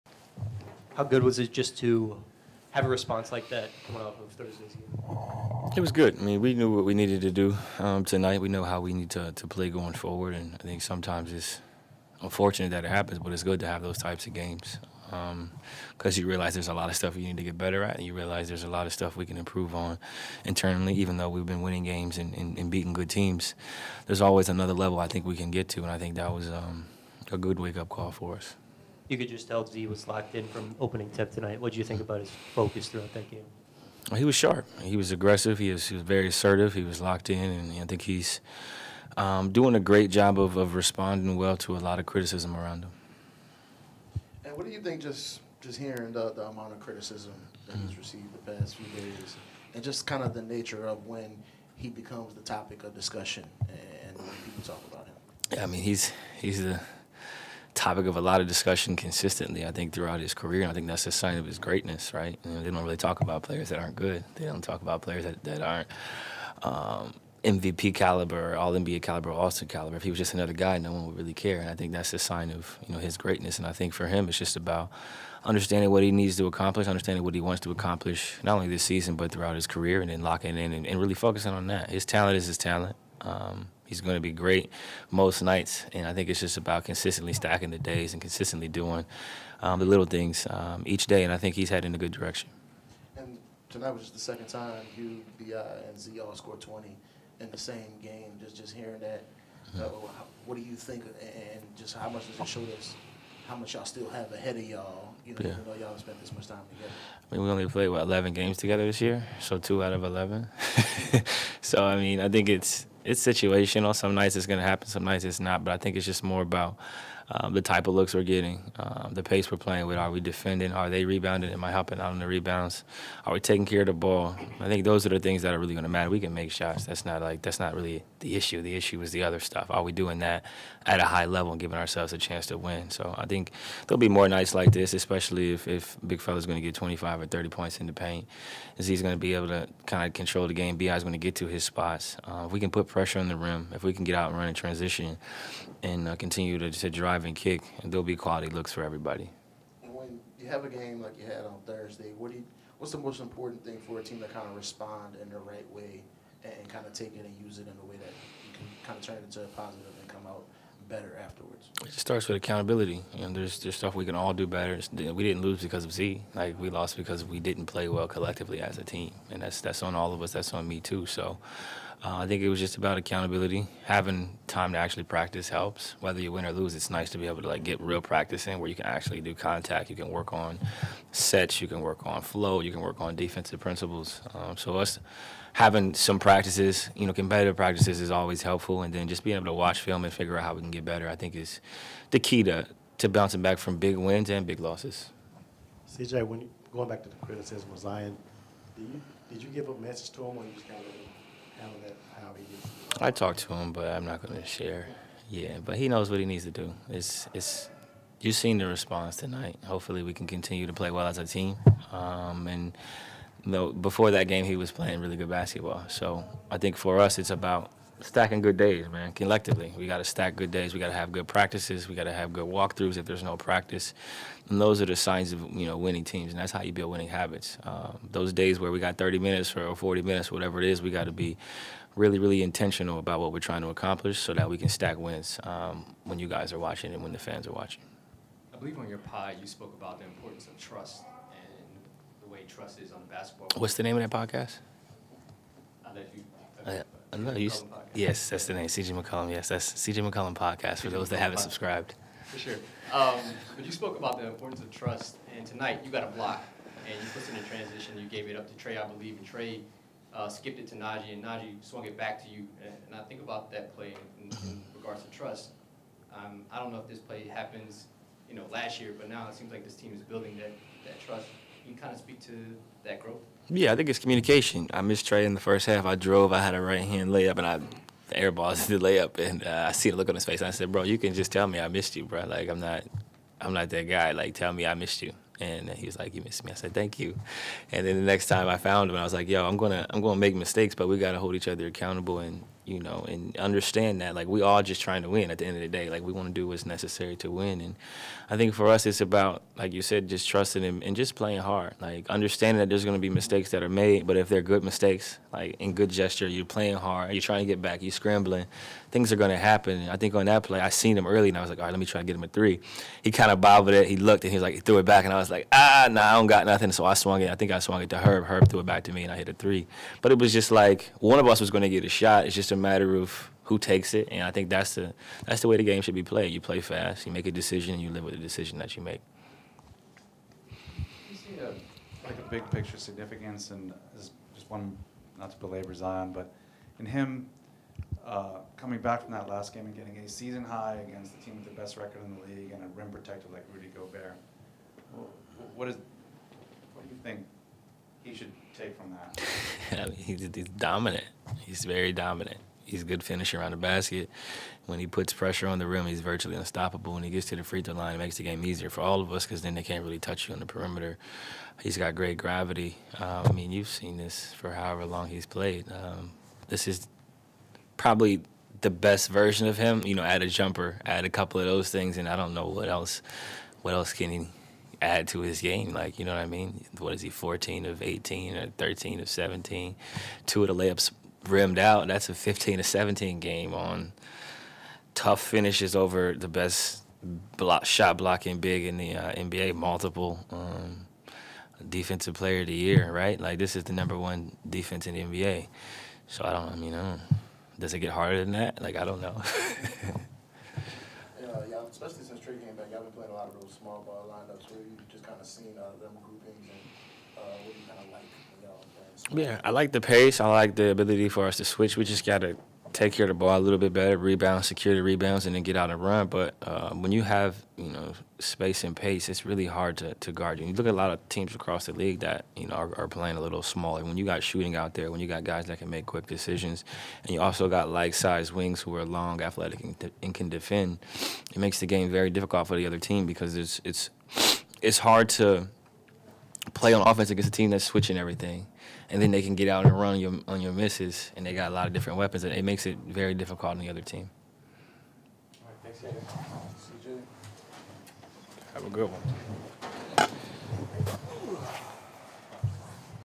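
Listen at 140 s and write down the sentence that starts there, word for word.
Bi's going to get to his spots.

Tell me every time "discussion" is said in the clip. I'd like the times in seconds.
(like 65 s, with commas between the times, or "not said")
52 s, 58 s.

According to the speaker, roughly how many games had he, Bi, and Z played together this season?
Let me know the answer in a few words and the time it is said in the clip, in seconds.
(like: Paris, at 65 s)
11, at 108 s.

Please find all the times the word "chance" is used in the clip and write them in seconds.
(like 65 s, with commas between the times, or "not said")
132 s.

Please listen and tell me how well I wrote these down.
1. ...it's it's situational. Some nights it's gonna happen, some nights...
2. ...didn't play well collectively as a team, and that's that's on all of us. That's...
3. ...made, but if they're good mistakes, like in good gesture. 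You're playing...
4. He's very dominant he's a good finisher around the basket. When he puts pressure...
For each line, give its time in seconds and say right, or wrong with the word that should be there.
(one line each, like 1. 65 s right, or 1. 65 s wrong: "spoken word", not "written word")
1. 112 s right
2. 167 s right
3. 303 s right
4. 351 s right.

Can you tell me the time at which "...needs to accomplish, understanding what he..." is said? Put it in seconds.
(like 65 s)
76 s.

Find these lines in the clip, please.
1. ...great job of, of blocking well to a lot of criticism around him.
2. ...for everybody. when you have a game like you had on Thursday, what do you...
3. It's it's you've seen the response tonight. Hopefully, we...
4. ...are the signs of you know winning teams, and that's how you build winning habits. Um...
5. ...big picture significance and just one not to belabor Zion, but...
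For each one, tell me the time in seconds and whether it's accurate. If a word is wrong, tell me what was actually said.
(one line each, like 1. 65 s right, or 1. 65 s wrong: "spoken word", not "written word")
1. 39 s wrong: "responding", not "blocking"
2. 148 s right
3. 206 s right
4. 224 s right
5. 332 s right.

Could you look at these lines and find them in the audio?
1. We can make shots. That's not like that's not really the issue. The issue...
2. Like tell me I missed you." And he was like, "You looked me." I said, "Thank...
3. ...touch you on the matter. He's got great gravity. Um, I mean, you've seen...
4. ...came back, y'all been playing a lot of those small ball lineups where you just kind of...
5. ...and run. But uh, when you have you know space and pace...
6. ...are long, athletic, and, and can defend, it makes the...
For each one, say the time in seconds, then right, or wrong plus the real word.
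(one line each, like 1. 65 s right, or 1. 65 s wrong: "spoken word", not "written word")
1. 126 s right
2. 284 s wrong: "missed", not "looked"
3. 359 s wrong: "perimeter", not "matter"
4. 402 s right
5. 415 s right
6. 428 s right.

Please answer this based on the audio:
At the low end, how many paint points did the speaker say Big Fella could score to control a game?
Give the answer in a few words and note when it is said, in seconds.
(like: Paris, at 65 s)
25, at 136 s.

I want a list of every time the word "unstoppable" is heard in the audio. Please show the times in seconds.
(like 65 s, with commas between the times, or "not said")
356 s.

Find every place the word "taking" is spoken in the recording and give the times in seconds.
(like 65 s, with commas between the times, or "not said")
123 s.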